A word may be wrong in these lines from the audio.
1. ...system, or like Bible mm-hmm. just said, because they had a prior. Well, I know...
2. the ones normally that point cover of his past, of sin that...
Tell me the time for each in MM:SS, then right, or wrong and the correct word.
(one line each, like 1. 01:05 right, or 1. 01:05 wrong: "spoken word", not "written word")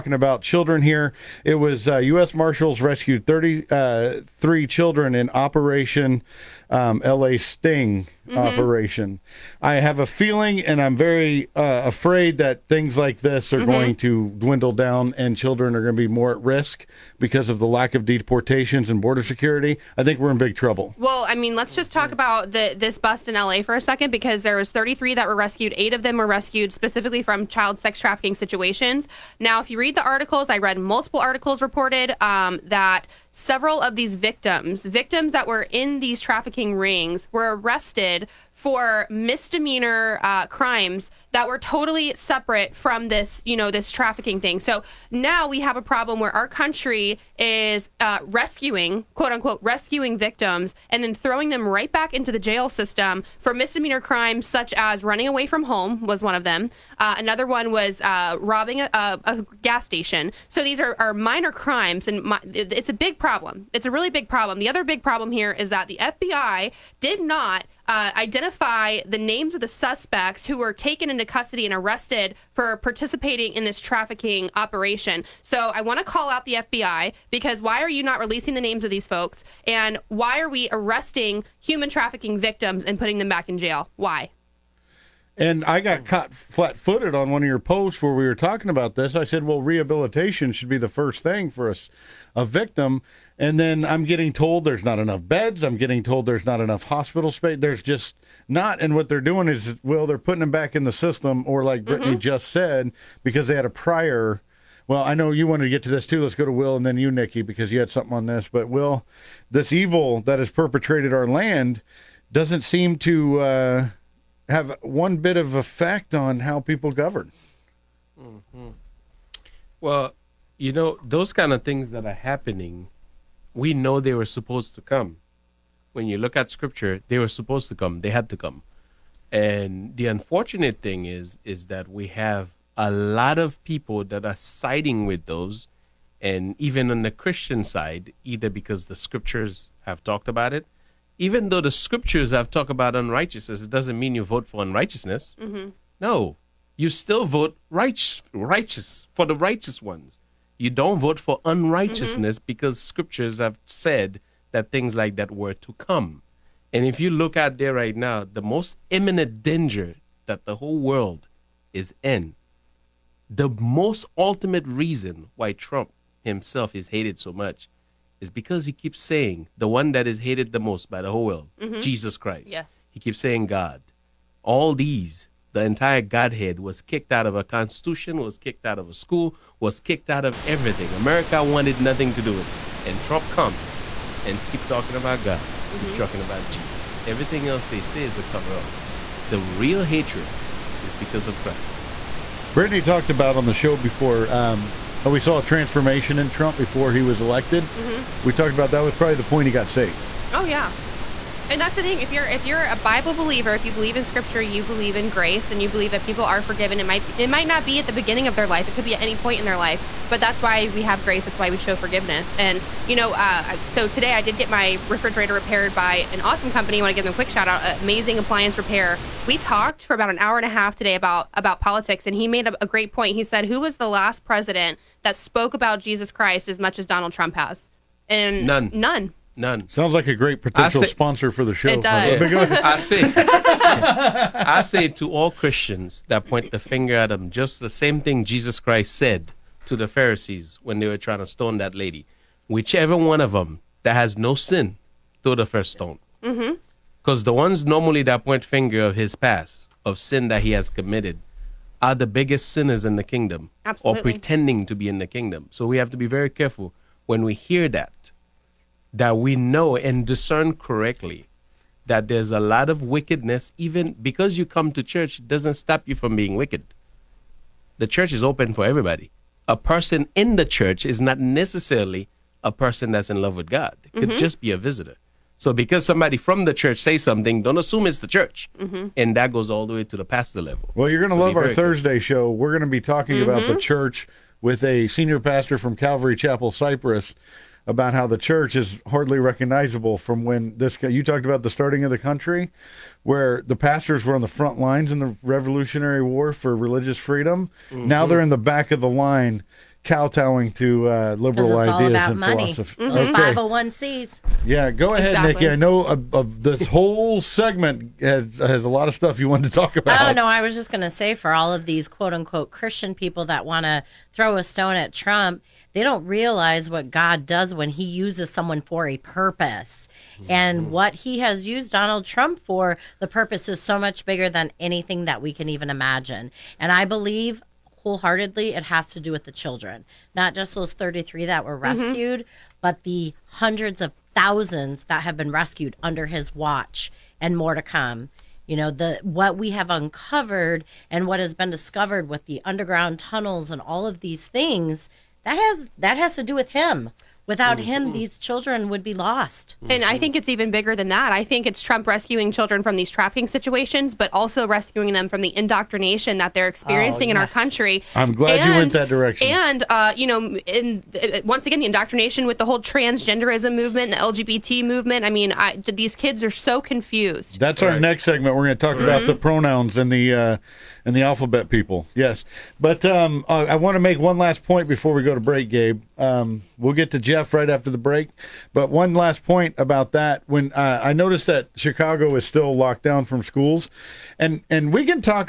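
1. 01:40 wrong: "Brittany", not "Bible"
2. 04:07 wrong: "finger", not "cover".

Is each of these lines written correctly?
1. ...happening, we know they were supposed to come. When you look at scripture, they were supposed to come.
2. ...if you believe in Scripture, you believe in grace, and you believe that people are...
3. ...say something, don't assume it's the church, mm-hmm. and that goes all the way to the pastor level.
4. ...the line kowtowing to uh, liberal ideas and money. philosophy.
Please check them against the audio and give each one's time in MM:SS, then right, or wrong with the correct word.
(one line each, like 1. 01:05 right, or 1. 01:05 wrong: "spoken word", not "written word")
1. 02:02 right
2. 03:23 right
3. 04:36 right
4. 04:58 right.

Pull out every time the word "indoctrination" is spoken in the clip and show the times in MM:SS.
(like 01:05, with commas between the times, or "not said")
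05:55, 06:01.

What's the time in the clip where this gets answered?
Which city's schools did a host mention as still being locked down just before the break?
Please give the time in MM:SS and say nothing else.
06:21.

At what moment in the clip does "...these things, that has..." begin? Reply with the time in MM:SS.
05:44.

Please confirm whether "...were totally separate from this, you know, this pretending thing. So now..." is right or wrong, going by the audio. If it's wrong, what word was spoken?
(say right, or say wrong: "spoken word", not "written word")
wrong: "trafficking", not "pretending".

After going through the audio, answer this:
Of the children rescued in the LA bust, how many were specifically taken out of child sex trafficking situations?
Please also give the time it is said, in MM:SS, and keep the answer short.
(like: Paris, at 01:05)
8, at 00:25.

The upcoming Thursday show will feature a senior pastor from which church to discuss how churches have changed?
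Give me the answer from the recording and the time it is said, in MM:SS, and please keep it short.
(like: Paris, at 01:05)
Calvary Chapel Cypress, at 04:45.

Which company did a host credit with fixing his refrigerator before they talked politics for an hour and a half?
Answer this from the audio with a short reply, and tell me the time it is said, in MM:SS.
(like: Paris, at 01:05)
Amazing appliance repair, at 03:37.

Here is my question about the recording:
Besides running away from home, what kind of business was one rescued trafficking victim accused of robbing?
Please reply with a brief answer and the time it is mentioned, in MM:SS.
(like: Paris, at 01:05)
gas station, at 00:59.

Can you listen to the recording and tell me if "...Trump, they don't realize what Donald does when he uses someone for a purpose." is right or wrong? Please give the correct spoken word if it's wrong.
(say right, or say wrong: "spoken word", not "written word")
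wrong: "God", not "Donald".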